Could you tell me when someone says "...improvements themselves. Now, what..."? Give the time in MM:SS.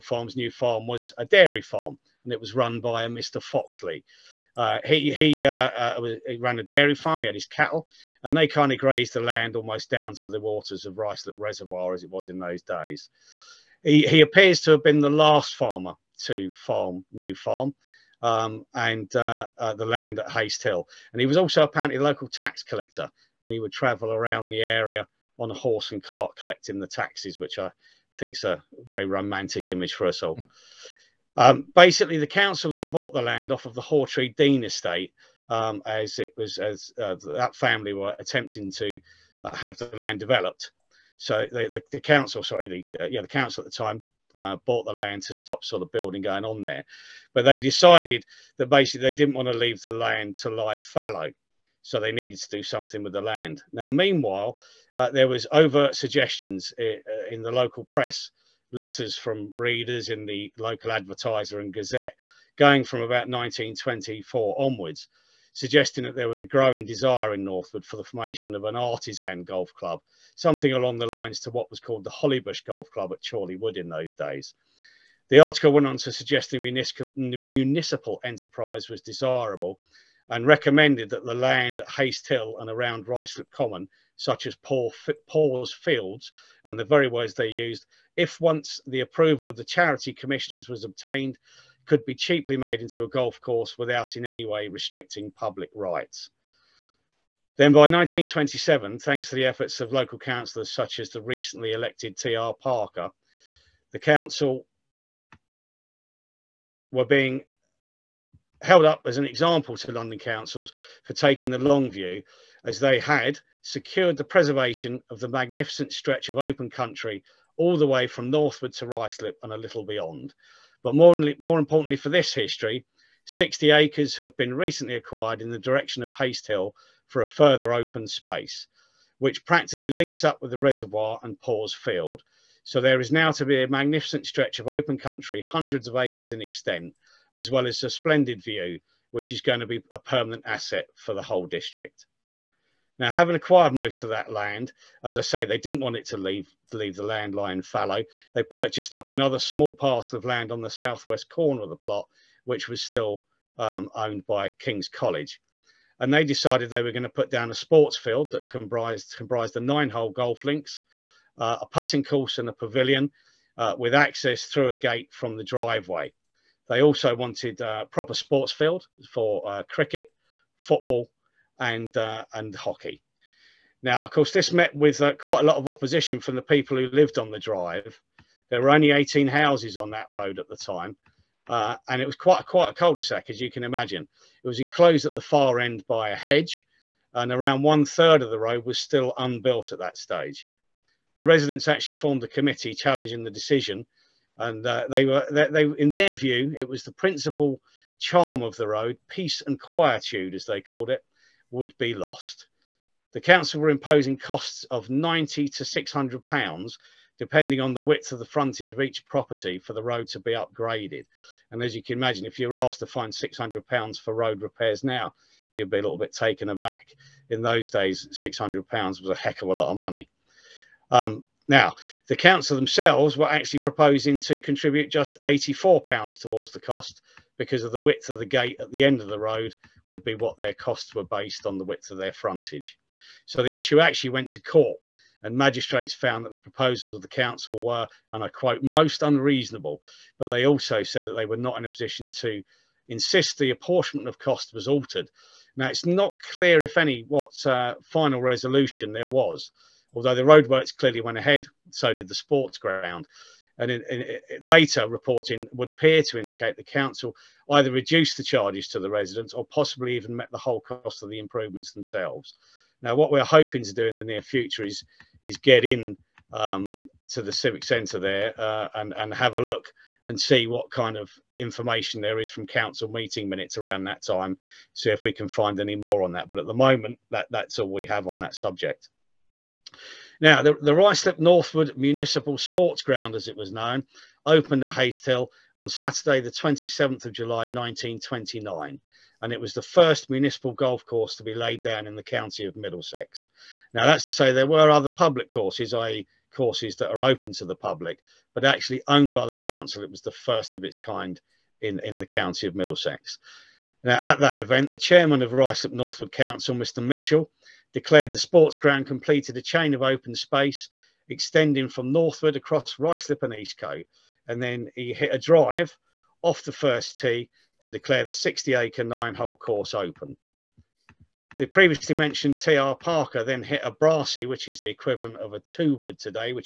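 04:21.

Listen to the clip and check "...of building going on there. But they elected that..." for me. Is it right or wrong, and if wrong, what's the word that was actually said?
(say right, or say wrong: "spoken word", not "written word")
wrong: "decided", not "elected".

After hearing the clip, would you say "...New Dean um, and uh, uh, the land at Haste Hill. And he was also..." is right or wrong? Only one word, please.
wrong.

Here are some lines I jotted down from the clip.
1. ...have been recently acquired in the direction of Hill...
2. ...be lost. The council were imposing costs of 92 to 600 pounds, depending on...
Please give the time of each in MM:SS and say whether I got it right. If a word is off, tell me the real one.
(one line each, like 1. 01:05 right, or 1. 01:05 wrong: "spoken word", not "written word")
1. 02:04 right
2. 03:21 wrong: "90", not "92".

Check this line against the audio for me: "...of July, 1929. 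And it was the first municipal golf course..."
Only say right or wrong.
right.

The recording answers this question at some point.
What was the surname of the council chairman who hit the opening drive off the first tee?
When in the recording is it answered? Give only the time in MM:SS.
05:06.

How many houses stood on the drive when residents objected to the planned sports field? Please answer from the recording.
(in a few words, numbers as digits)
18.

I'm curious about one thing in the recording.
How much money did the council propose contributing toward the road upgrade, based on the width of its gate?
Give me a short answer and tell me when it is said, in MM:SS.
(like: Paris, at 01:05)
84 pounds, at 03:45.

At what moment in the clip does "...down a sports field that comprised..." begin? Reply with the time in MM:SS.
02:37.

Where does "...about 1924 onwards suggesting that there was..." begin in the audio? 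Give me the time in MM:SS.
01:03.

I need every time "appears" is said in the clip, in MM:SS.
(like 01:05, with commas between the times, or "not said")
00:14, 04:15.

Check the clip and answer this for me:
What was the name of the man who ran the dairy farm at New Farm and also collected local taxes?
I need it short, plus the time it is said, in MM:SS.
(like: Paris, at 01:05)
Mr. Foxley, at 00:03.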